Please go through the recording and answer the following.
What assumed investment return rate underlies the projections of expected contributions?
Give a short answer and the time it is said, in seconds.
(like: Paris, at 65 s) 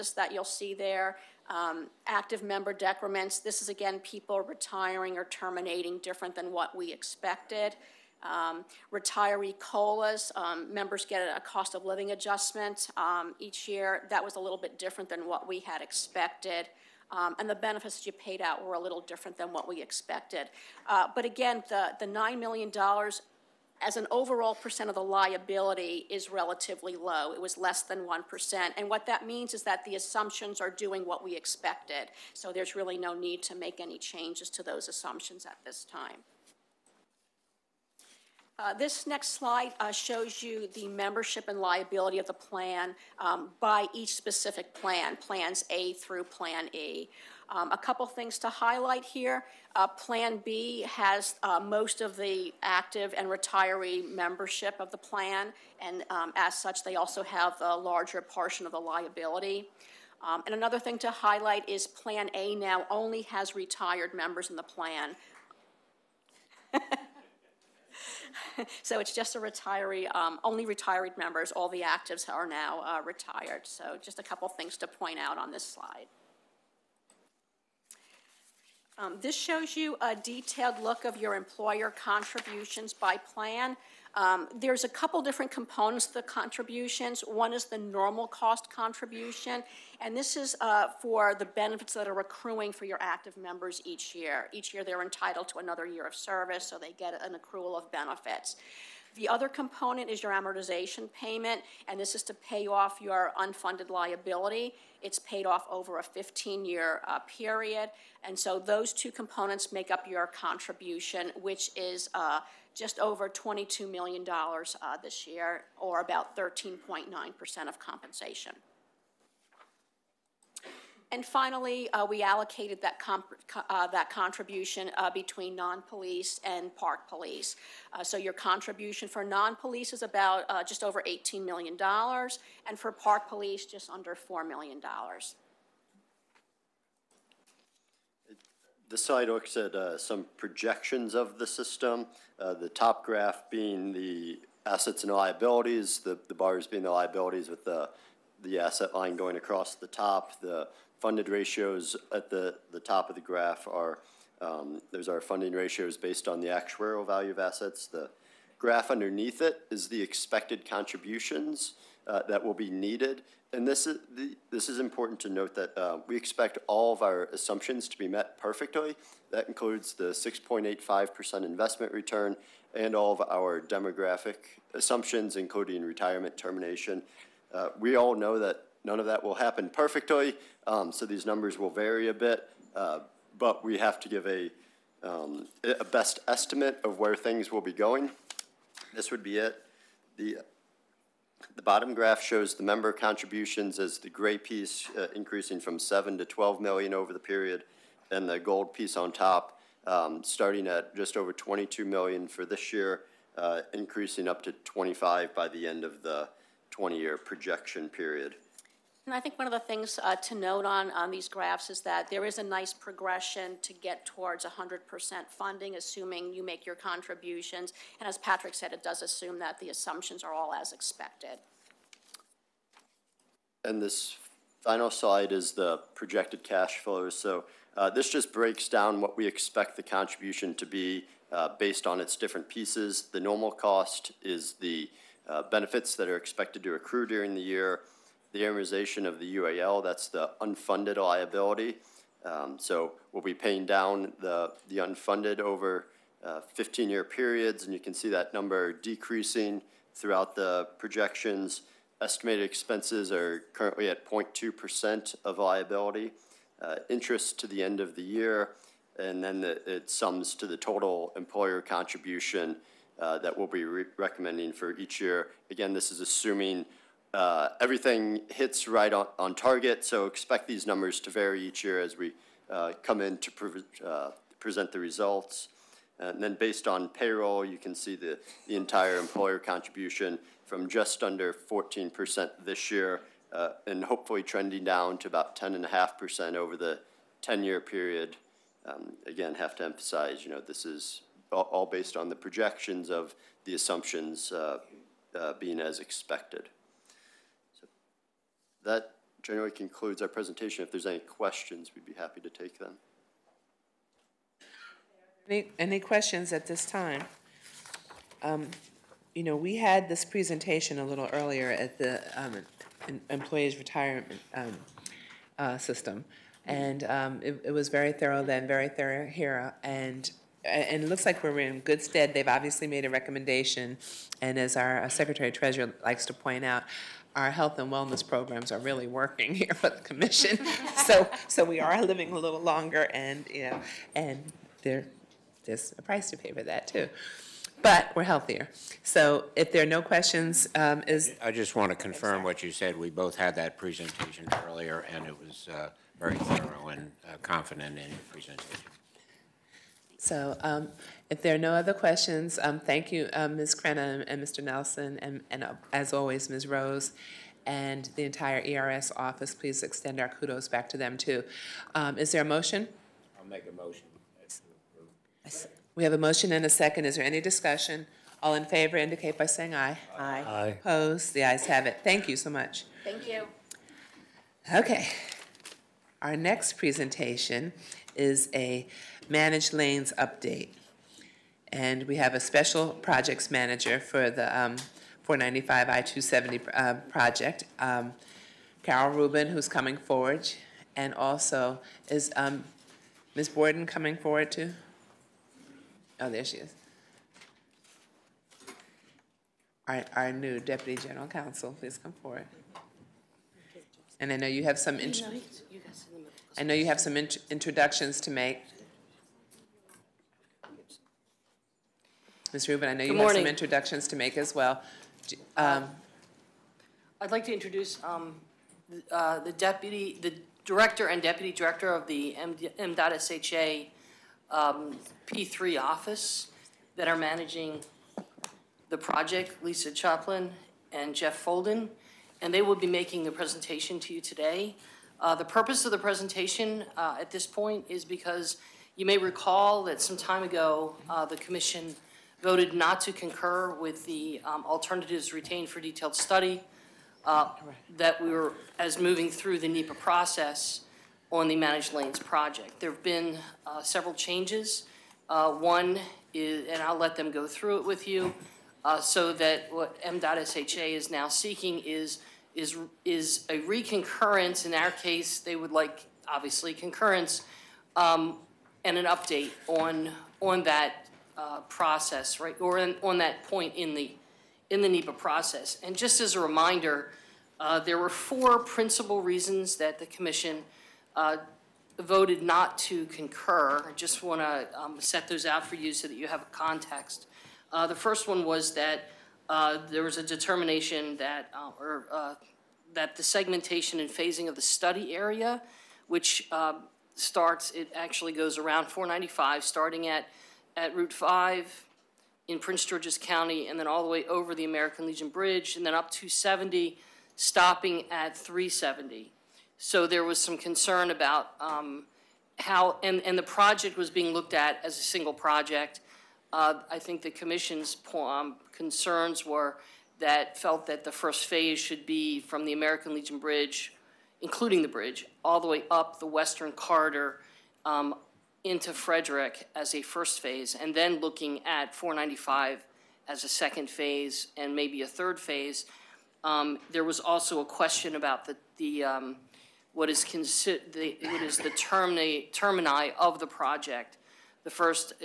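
6.85%, at 170 s.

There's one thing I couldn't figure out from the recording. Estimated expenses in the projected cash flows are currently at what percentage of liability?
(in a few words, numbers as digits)
0.2%.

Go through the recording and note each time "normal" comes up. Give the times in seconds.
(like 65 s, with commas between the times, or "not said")
87 s, 233 s.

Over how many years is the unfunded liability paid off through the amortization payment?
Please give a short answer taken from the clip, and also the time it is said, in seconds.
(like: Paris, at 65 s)
15 years, at 106 s.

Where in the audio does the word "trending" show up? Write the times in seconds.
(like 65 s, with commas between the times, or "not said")
284 s.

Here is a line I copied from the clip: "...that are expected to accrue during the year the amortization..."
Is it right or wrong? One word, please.
right.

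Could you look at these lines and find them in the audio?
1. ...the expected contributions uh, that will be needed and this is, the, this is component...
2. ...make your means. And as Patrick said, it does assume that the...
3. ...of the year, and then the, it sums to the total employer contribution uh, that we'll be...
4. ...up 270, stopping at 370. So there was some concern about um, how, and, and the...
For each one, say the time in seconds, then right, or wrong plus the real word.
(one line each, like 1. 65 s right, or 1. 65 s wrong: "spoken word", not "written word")
1. 159 s wrong: "important", not "component"
2. 216 s wrong: "contributions", not "means"
3. 257 s right
4. 505 s right.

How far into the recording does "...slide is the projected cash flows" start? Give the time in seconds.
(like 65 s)
224 s.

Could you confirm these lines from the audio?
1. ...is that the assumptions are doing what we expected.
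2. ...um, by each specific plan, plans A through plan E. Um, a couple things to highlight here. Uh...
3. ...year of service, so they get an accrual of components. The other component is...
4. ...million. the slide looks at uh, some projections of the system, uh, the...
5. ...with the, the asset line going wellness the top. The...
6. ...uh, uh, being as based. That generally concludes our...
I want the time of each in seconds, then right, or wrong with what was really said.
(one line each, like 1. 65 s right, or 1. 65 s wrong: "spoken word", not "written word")
1. 29 s right
2. 43 s right
3. 95 s wrong: "benefits", not "components"
4. 134 s right
5. 147 s wrong: "across", not "wellness"
6. 294 s wrong: "expected", not "based".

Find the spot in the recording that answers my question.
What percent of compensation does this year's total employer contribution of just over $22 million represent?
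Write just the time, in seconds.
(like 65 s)
116 s.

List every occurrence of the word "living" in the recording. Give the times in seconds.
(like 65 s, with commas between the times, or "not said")
11 s, 331 s.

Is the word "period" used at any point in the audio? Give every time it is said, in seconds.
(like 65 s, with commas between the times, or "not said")
107 s, 197 s, 207 s, 247 s, 287 s.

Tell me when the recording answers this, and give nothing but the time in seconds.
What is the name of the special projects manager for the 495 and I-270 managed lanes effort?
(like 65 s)
388 s.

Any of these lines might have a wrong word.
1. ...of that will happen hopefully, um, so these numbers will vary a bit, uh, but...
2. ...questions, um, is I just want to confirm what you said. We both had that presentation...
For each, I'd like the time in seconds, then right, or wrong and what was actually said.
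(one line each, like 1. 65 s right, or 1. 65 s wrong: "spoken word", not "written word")
1. 178 s wrong: "perfectly", not "hopefully"
2. 339 s right.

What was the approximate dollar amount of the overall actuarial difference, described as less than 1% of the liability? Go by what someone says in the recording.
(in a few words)
$9 million.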